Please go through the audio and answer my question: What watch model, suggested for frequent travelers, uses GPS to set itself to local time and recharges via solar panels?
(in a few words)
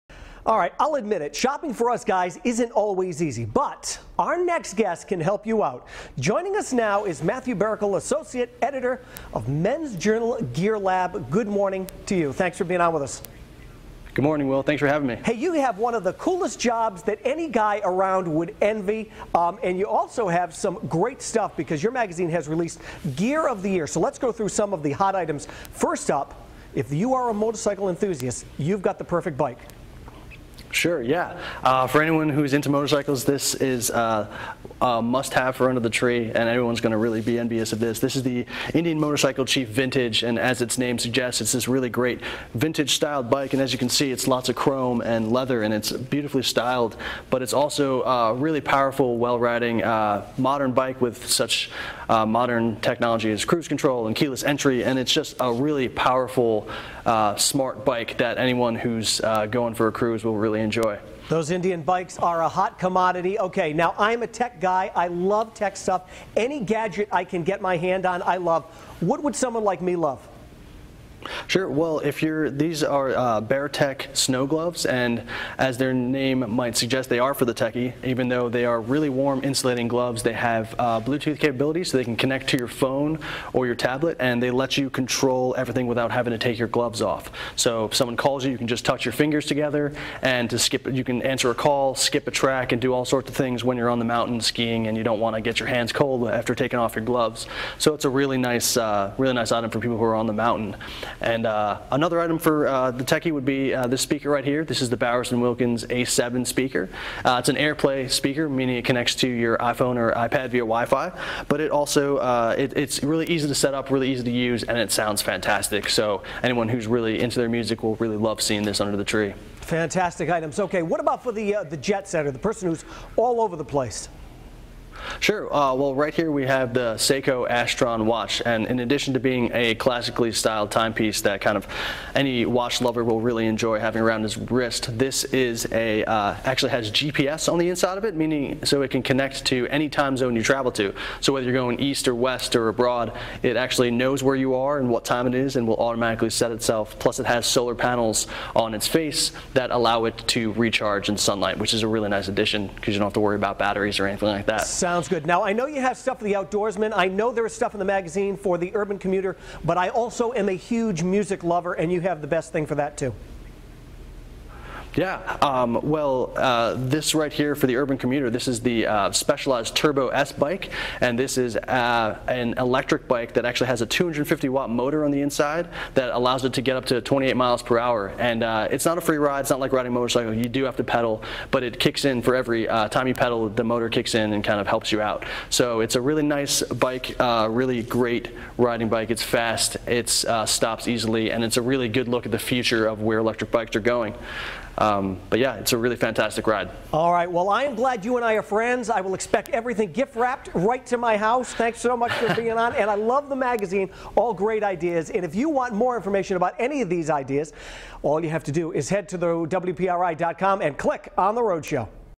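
Seiko Astron.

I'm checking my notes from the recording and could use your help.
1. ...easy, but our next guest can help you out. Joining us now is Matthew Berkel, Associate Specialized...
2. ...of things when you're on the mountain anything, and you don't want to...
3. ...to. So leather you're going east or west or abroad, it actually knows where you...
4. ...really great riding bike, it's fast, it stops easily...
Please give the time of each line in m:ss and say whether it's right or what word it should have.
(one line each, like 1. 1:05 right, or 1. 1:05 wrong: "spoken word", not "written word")
1. 0:03 wrong: "Editor", not "Specialized"
2. 1:33 wrong: "skiing", not "anything"
3. 2:20 wrong: "whether", not "leather"
4. 3:07 right.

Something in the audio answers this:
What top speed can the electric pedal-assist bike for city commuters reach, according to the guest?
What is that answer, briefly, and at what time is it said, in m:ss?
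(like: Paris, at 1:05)
28 miles per hour, at 2:56.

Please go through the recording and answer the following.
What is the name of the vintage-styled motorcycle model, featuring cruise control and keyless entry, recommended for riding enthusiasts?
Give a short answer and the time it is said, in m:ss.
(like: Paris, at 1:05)
Indian Motorcycle Chief Vintage, at 0:38.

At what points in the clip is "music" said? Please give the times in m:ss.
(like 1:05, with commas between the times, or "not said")
1:57, 2:41.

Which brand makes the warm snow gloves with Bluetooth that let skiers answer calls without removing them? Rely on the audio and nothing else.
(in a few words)
BearTek.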